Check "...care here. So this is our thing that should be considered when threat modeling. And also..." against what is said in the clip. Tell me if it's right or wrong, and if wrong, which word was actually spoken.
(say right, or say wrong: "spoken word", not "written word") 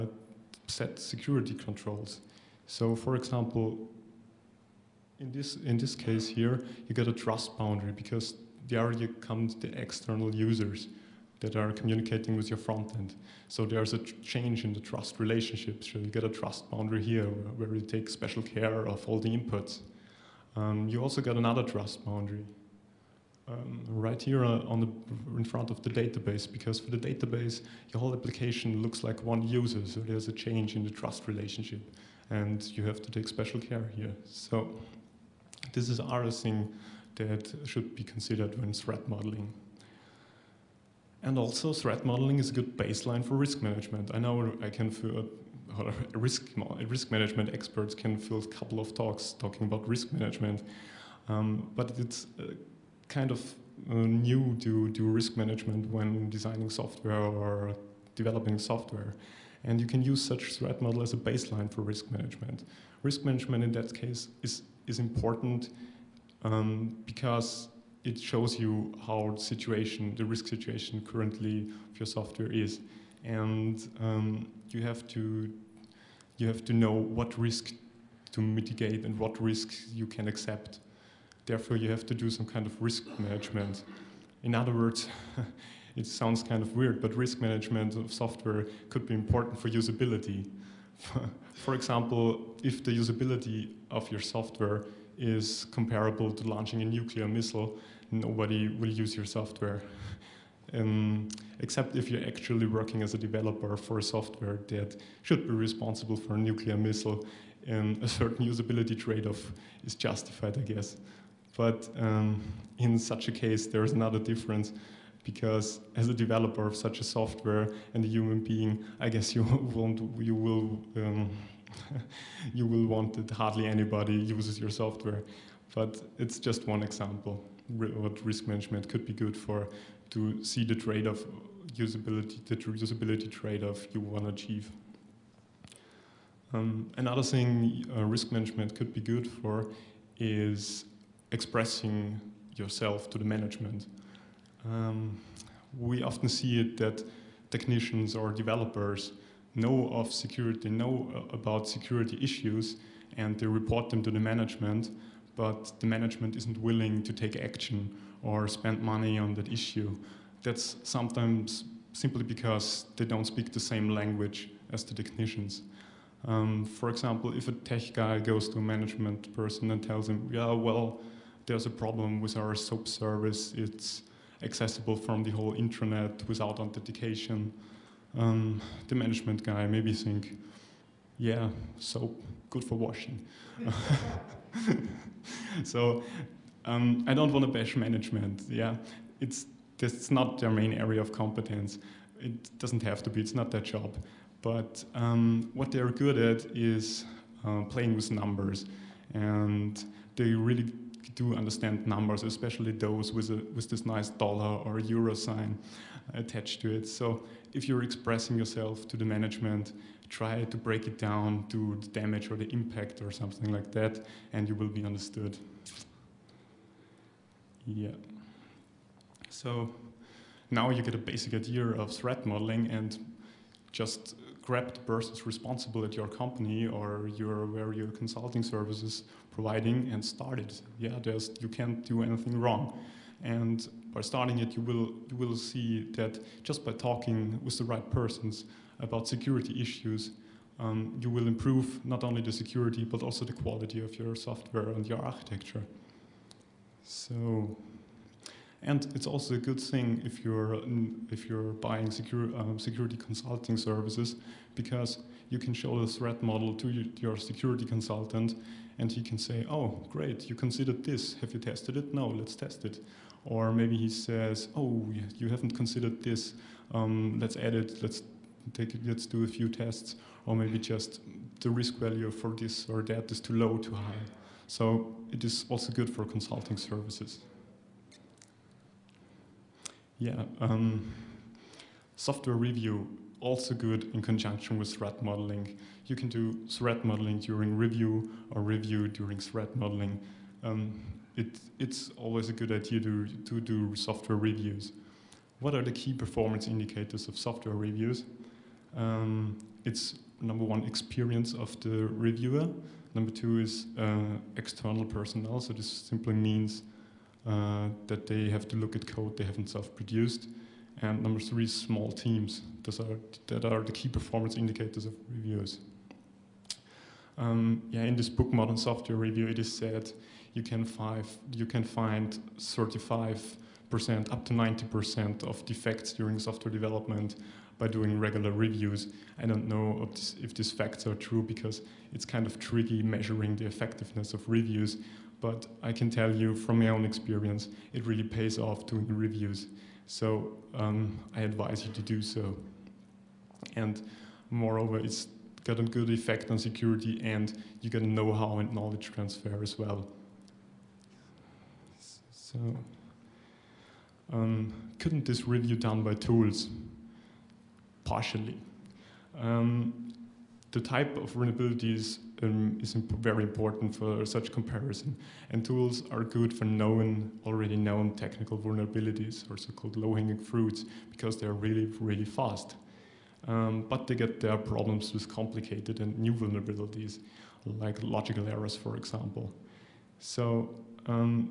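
right.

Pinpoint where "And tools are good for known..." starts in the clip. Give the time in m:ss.
6:05.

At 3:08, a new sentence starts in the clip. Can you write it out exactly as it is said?
Yeah, it's that's not their main area of competence.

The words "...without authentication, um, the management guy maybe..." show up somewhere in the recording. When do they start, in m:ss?
2:56.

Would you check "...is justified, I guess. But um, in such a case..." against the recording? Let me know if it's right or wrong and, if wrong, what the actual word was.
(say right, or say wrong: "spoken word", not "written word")
right.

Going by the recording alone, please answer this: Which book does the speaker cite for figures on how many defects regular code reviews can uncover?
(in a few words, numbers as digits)
Modern Software Review.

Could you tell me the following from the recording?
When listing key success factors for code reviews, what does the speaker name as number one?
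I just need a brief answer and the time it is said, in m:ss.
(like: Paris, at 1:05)
experience of the reviewer, at 5:00.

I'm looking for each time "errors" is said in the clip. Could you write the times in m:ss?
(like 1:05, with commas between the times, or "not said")
6:18.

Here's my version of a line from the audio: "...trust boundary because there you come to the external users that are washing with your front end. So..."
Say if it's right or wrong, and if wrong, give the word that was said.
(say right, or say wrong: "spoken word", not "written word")
wrong: "communicating", not "washing".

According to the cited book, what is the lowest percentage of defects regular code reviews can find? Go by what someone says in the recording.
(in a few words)
35%.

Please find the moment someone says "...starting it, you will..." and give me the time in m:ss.
3:54.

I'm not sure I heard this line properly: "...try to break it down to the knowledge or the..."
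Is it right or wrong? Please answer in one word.
wrong.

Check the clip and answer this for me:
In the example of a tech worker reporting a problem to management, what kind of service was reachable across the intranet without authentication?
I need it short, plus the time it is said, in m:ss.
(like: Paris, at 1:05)
SOAP service, at 2:52.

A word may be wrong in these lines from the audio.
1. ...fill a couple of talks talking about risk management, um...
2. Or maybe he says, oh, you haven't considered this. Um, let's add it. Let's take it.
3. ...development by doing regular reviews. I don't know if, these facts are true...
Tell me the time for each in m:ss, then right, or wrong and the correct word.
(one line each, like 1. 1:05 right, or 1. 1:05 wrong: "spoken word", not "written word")
1. 0:48 right
2. 4:23 right
3. 5:26 right.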